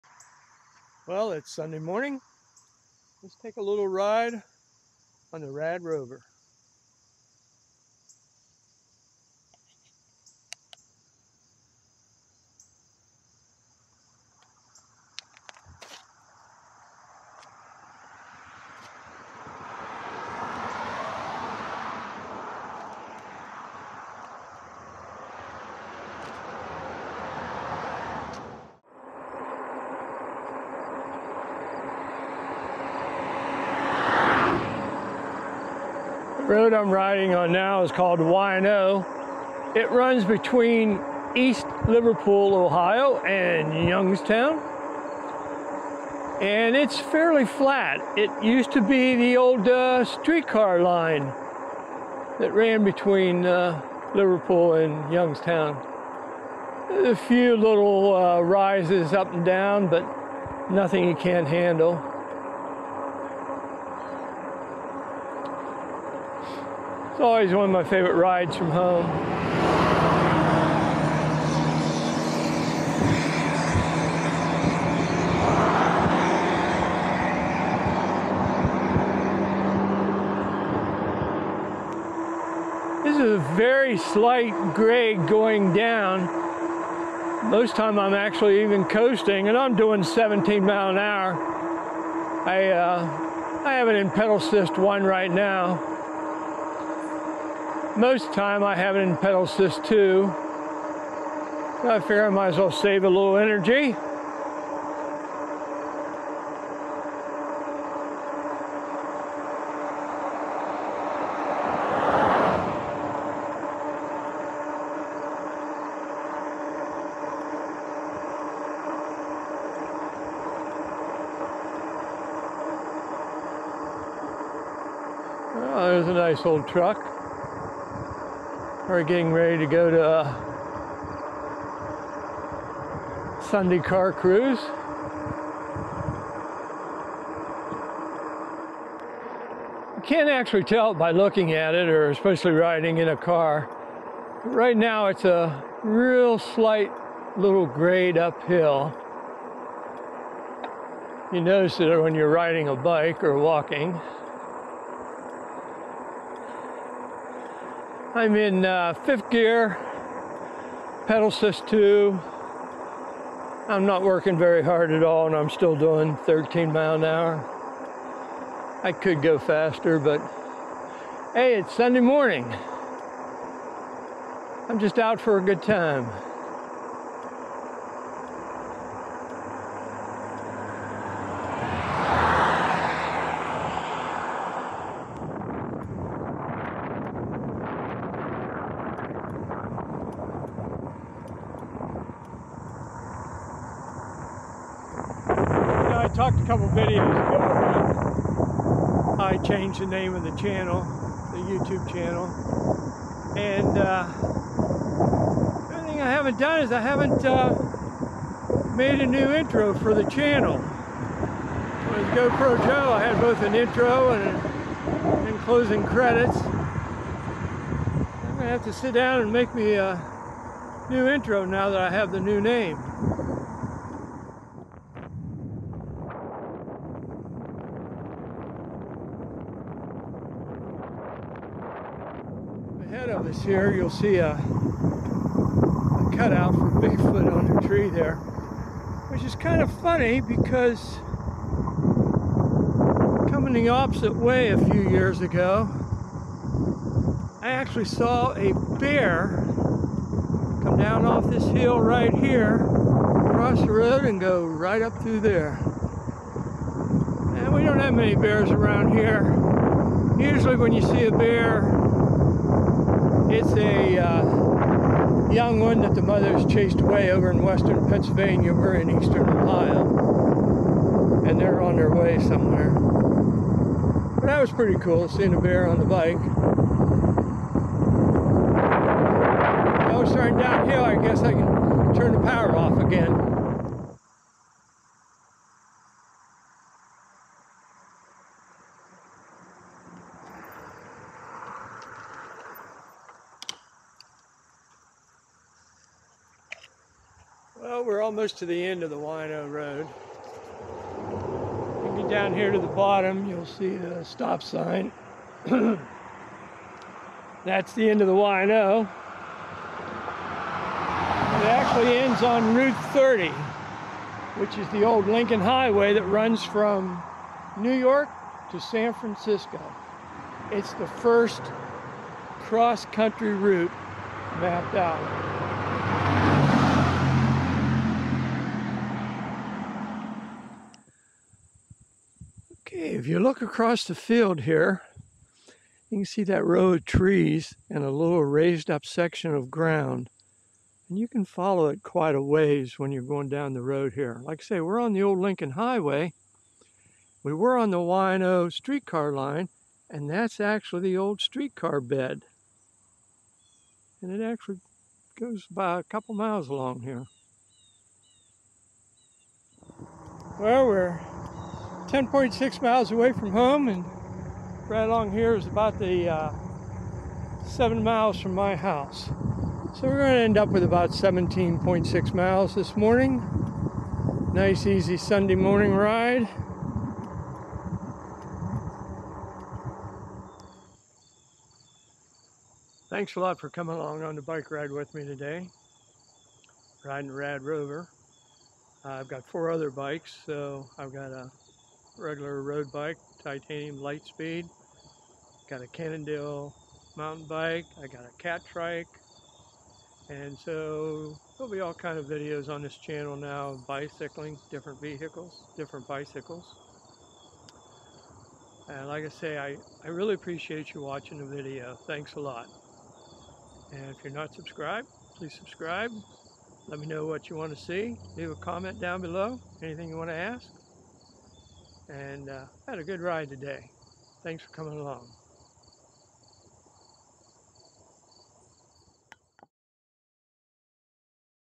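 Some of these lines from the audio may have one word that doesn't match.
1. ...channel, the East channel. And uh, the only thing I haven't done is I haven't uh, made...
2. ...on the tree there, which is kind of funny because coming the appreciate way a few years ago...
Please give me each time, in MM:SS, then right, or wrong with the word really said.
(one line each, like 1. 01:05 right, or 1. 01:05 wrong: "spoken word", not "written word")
1. 03:20 wrong: "YouTube", not "East"
2. 03:57 wrong: "opposite", not "appreciate".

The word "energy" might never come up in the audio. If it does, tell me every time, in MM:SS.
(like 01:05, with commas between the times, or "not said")
01:43.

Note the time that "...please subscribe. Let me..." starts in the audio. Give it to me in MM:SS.
06:55.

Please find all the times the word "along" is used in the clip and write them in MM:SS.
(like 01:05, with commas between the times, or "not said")
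05:56, 06:04, 06:23, 07:04.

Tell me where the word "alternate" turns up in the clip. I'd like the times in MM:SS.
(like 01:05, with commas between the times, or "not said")
not said.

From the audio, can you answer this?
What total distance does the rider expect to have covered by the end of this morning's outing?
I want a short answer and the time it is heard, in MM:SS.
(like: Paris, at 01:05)
17.6 miles, at 06:10.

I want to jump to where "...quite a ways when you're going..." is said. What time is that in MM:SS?
05:41.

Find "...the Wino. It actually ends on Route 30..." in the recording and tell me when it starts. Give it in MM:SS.
05:08.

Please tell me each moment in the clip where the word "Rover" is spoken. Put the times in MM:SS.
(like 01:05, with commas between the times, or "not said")
00:05, 06:27.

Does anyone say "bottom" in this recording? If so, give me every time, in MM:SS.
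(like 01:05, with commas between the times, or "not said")
05:02.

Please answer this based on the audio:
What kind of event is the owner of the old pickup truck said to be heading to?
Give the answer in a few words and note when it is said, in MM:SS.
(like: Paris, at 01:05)
Sunday car cruise, at 02:13.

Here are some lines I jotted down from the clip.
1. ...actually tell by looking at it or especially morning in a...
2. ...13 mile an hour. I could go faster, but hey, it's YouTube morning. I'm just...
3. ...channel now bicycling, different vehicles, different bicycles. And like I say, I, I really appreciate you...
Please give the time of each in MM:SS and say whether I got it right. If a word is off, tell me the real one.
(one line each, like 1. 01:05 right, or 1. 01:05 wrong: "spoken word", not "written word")
1. 02:20 wrong: "riding", not "morning"
2. 02:46 wrong: "Sunday", not "YouTube"
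3. 06:42 right.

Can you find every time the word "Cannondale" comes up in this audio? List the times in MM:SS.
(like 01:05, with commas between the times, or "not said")
06:35.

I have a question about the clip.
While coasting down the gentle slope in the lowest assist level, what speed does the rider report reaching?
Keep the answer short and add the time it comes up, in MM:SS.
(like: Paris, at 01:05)
17 mph, at 01:30.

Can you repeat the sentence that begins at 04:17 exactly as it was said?
And we don't have many bears around here.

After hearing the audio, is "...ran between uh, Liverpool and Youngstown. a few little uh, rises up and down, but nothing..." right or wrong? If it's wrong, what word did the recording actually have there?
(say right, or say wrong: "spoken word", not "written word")
right.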